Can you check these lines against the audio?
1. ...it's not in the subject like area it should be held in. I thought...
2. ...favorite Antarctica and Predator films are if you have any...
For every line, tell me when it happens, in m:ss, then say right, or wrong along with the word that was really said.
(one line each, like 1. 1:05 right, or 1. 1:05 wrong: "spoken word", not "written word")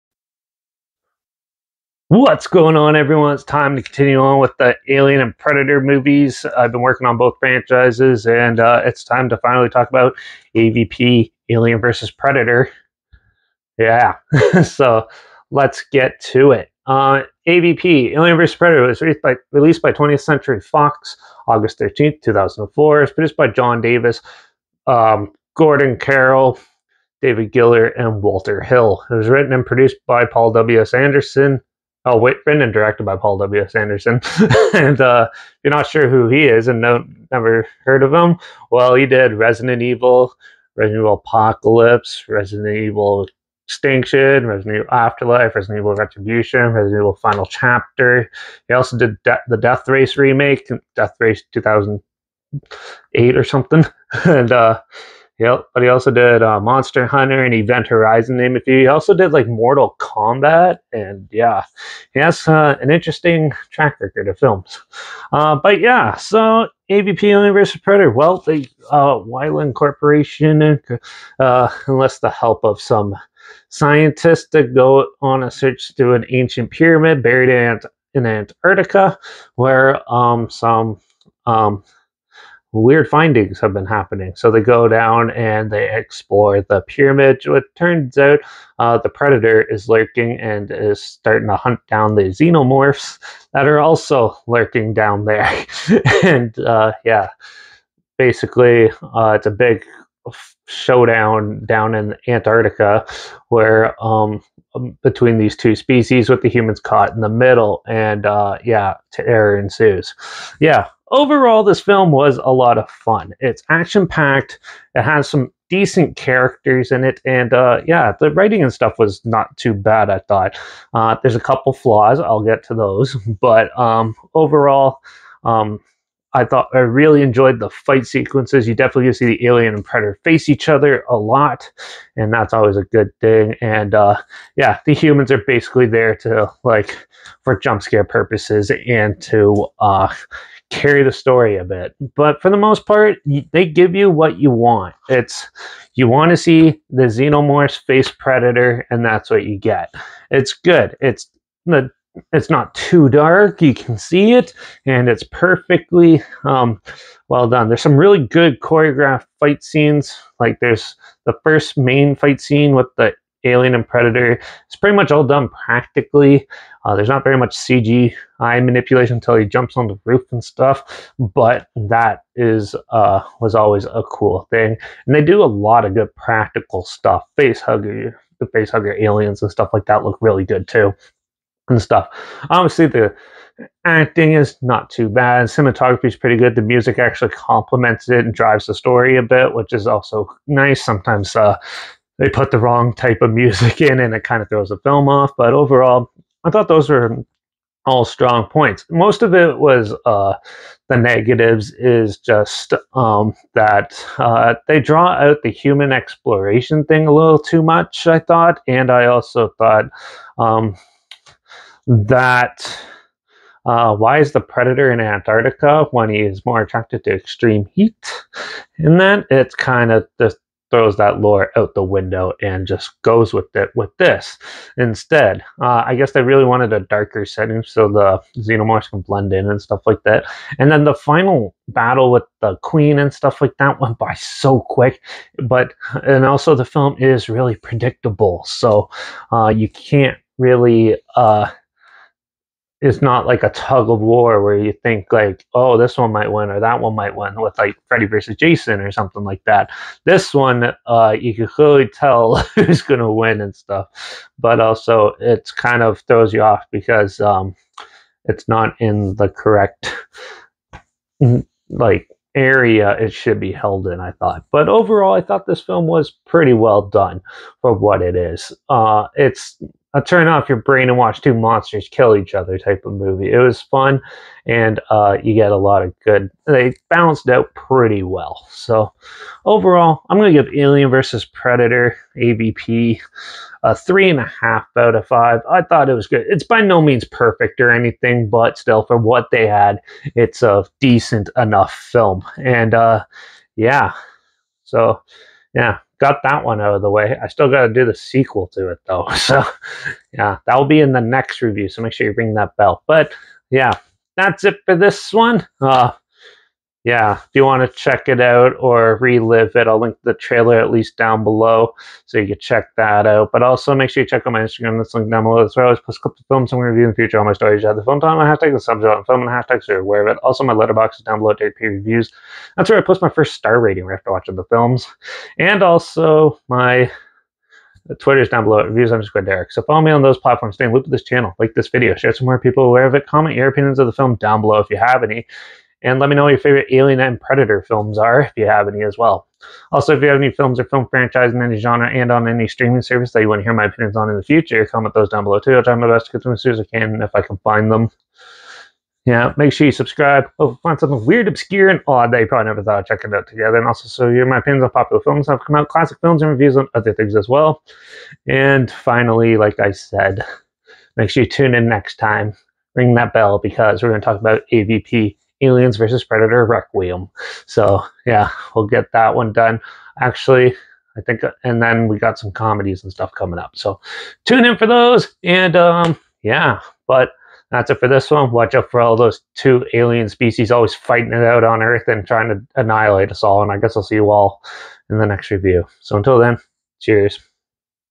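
1. 4:18 wrong: "correct", not "subject"
2. 5:36 wrong: "Alien", not "Antarctica".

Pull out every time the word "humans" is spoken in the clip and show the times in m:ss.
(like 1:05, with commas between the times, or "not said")
1:46, 2:14, 3:25.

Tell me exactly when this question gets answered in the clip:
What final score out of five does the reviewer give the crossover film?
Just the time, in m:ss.
4:43.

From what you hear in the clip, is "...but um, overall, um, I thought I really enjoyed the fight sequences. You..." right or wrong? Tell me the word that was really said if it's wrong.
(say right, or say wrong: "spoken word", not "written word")
right.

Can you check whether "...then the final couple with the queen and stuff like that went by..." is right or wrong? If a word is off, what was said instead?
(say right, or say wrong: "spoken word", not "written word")
wrong: "battle", not "couple".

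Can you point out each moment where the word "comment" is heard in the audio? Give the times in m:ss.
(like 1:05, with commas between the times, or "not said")
5:33, 5:44.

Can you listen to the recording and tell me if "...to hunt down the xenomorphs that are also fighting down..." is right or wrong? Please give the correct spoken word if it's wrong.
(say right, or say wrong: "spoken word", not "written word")
wrong: "lurking", not "fighting".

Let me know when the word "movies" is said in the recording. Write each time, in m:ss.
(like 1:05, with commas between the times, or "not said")
0:05, 4:32.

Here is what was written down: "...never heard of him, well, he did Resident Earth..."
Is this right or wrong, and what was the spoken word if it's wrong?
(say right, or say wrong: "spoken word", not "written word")
wrong: "Evil", not "Earth".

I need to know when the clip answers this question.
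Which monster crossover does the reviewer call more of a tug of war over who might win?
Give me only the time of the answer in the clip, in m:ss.
4:07.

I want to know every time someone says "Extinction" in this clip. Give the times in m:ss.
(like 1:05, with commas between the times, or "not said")
0:43.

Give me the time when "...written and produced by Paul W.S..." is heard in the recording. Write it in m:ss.
0:29.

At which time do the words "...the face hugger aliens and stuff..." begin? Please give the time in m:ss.
2:58.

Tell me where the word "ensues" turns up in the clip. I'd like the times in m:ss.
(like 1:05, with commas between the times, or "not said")
1:49.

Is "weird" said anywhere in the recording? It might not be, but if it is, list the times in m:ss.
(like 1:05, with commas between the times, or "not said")
1:22, 5:51.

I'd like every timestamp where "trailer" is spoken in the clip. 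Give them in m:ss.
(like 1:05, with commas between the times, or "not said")
5:10.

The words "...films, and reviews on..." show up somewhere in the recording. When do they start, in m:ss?
5:56.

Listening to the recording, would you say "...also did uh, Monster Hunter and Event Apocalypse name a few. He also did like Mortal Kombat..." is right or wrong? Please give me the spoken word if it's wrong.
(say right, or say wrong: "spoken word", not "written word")
wrong: "Horizon", not "Apocalypse".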